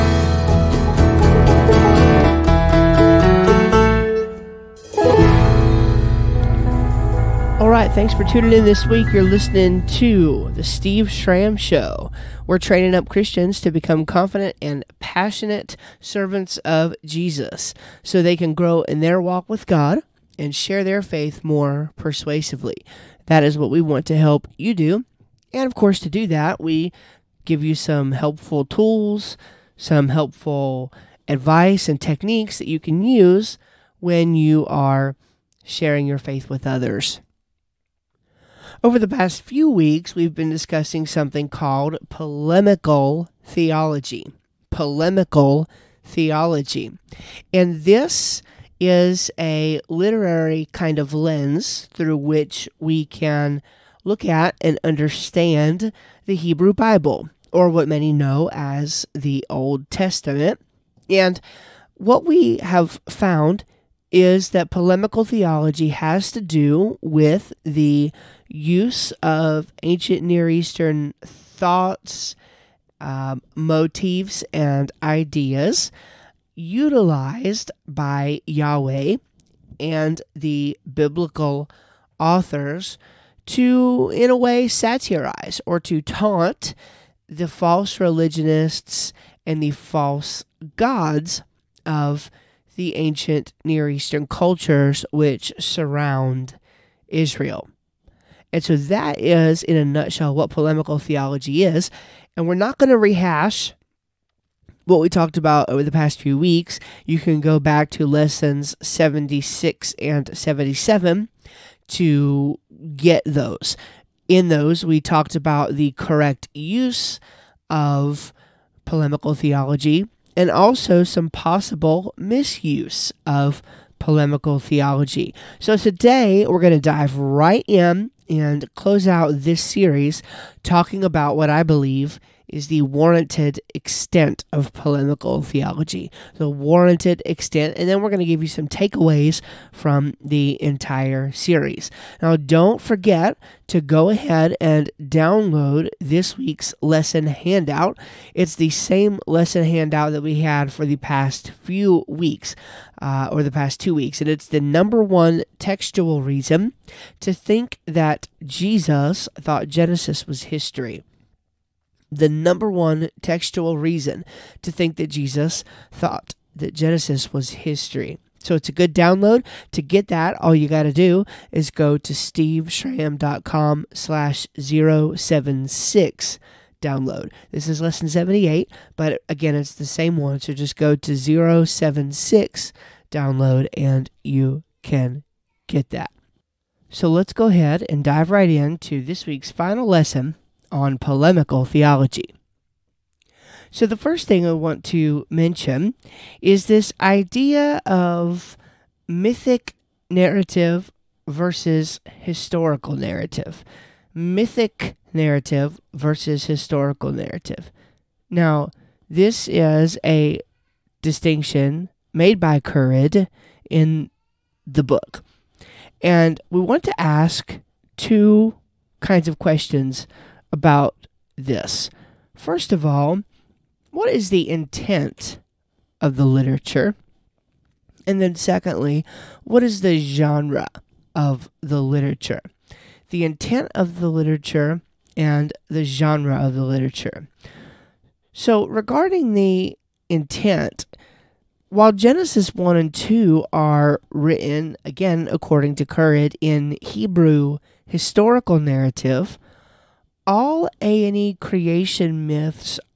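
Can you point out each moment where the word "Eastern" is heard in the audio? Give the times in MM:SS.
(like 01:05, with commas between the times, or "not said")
01:10, 01:33.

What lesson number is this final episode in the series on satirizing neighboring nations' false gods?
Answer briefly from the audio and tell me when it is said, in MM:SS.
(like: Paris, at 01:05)
78, at 02:57.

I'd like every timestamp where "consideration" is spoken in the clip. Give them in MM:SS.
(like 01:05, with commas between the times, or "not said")
not said.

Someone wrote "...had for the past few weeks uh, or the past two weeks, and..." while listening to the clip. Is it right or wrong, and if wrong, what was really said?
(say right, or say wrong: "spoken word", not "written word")
right.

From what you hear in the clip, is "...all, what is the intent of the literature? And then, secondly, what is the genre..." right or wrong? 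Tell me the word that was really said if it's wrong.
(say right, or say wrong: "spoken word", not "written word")
right.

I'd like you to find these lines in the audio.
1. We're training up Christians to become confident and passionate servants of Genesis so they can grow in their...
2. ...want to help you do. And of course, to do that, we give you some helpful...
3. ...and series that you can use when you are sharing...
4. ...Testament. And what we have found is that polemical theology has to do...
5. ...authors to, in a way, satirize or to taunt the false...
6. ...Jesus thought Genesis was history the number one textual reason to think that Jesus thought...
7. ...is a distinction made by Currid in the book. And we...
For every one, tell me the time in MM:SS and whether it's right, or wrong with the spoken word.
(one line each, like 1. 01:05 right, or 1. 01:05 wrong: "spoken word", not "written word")
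1. 00:12 wrong: "Jesus", not "Genesis"
2. 00:23 right
3. 00:31 wrong: "techniques", not "series"
4. 00:59 right
5. 01:22 right
6. 02:38 right
7. 03:29 right.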